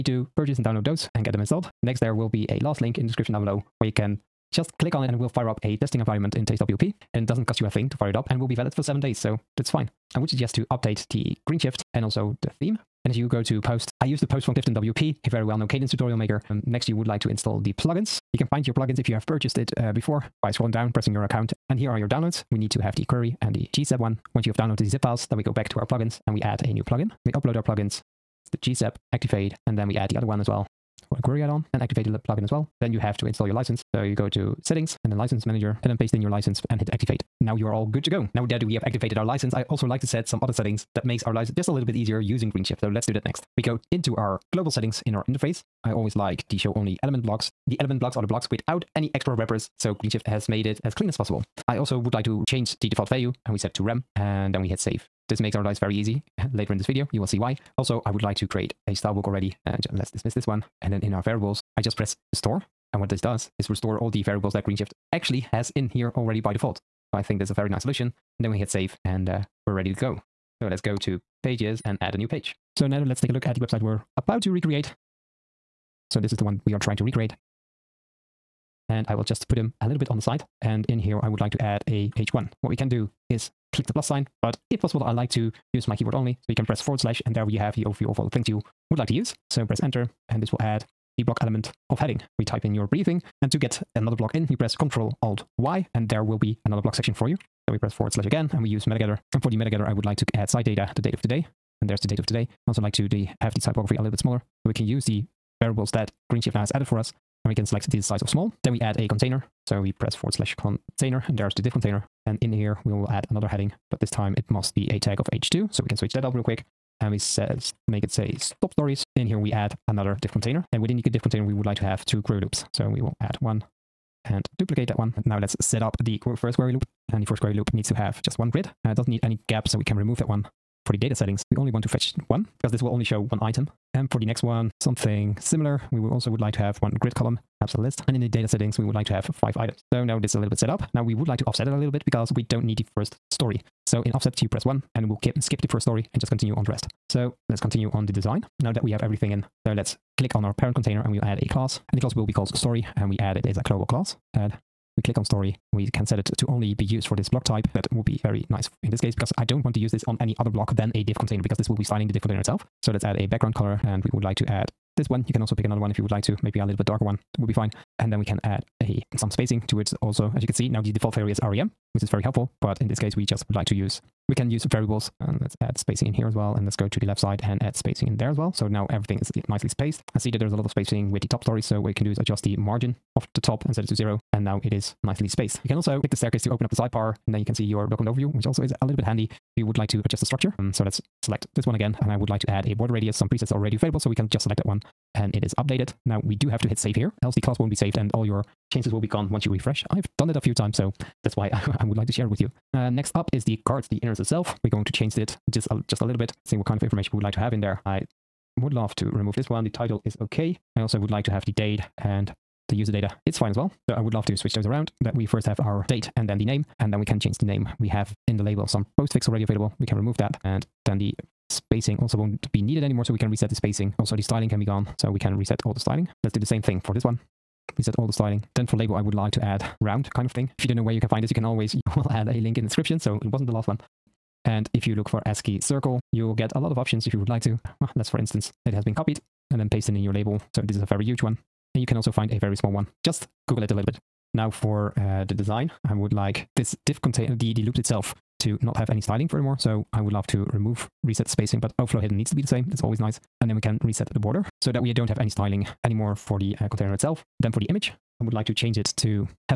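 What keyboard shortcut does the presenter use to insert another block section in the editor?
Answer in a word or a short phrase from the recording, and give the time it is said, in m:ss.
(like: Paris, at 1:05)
Control Alt Y, at 1:34.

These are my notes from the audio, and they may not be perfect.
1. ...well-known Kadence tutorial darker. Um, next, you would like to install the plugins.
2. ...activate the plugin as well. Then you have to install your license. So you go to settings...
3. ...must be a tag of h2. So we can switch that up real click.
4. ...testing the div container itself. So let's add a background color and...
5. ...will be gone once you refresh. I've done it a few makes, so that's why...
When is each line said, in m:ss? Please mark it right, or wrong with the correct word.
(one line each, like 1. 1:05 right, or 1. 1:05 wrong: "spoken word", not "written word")
1. 0:15 wrong: "maker", not "darker"
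2. 0:31 right
3. 1:54 wrong: "quick", not "click"
4. 2:41 wrong: "styling", not "testing"
5. 3:18 wrong: "times", not "makes".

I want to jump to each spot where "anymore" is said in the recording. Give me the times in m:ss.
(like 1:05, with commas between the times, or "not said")
3:42, 4:15.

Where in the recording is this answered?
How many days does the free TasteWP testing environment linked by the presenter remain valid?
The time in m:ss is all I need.
0:08.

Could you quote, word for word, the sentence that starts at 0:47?
The element blocks are the blocks without any extra wrappers.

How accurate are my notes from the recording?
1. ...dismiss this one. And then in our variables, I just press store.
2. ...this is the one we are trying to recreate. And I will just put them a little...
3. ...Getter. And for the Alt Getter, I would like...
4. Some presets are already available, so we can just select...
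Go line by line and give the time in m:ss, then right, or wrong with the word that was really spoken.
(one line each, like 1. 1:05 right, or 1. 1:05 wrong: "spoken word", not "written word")
1. 1:00 right
2. 1:16 right
3. 1:38 wrong: "Meta", not "Alt"
4. 3:13 right.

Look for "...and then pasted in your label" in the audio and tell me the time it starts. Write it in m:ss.
3:59.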